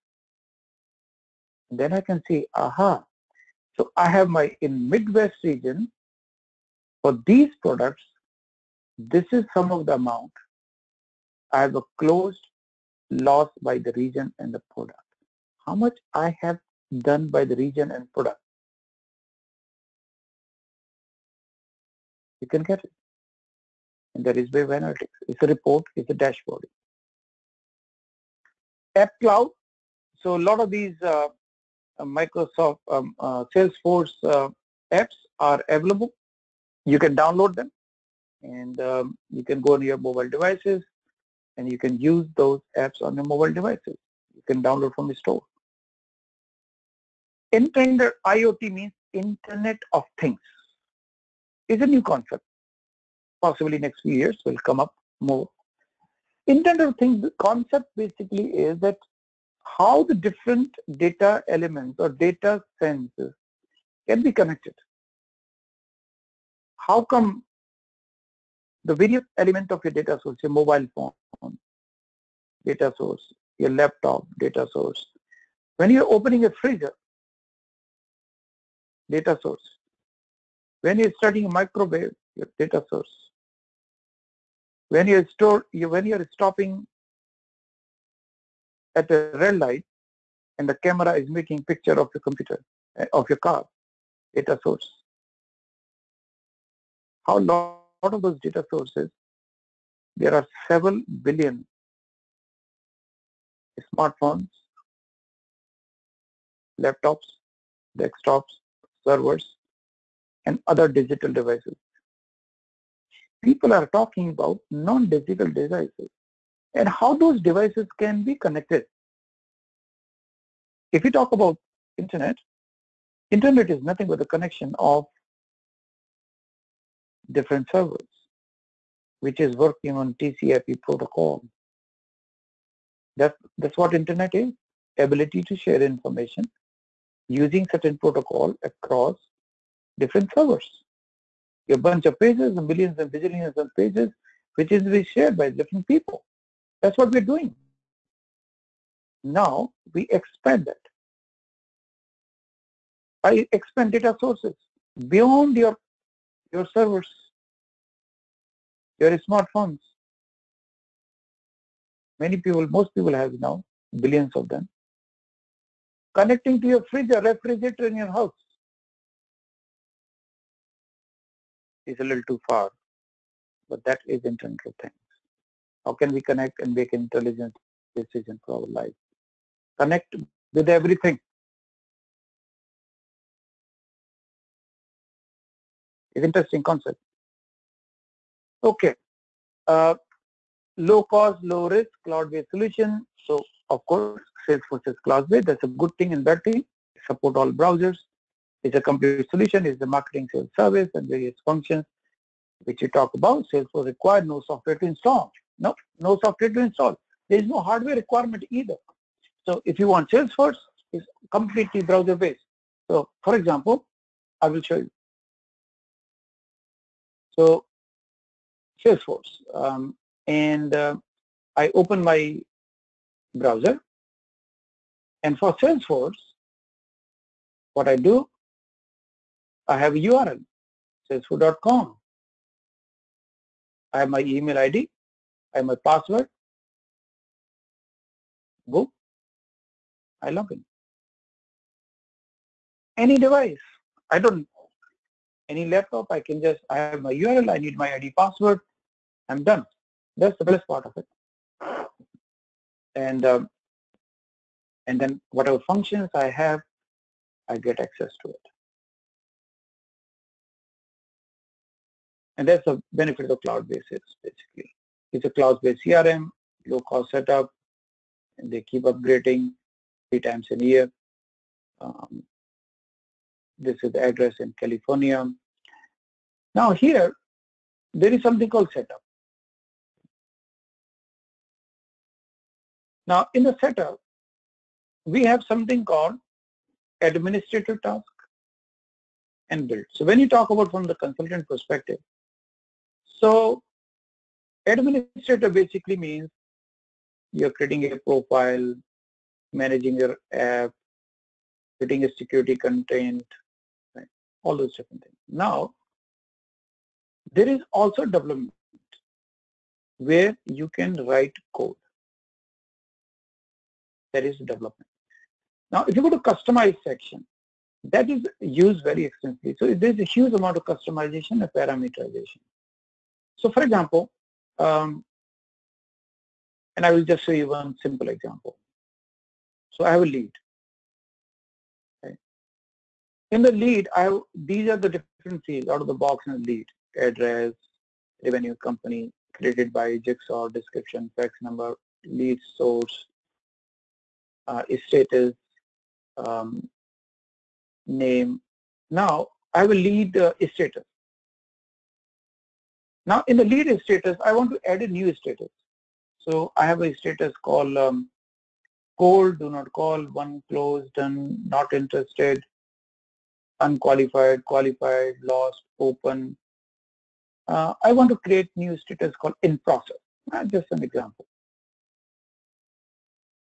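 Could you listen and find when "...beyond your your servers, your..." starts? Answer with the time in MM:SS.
02:35.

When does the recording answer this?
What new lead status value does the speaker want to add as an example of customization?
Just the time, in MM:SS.
06:09.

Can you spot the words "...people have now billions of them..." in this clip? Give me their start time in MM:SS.
02:42.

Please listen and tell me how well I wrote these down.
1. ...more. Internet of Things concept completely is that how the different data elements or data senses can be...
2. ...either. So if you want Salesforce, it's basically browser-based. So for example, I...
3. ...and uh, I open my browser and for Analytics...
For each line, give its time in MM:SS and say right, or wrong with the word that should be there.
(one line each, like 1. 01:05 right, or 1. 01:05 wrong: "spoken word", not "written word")
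1. 00:55 wrong: "basically", not "completely"
2. 03:28 wrong: "completely", not "basically"
3. 03:40 wrong: "Salesforce", not "Analytics".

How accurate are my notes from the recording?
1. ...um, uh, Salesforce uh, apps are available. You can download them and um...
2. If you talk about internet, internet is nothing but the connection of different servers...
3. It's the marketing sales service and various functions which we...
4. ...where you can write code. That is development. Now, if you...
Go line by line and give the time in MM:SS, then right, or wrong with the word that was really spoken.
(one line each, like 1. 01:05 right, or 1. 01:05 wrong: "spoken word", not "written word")
1. 00:32 right
2. 02:00 right
3. 03:19 right
4. 05:09 right.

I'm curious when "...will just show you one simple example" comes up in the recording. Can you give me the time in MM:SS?
05:26.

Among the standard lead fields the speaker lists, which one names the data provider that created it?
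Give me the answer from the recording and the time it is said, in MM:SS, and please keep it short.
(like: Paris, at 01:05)
Jigsaw, at 05:39.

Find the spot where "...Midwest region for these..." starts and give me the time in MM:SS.
00:04.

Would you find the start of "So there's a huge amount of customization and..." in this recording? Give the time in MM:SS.
05:19.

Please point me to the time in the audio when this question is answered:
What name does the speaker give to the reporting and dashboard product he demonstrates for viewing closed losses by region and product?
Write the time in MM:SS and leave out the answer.
00:24.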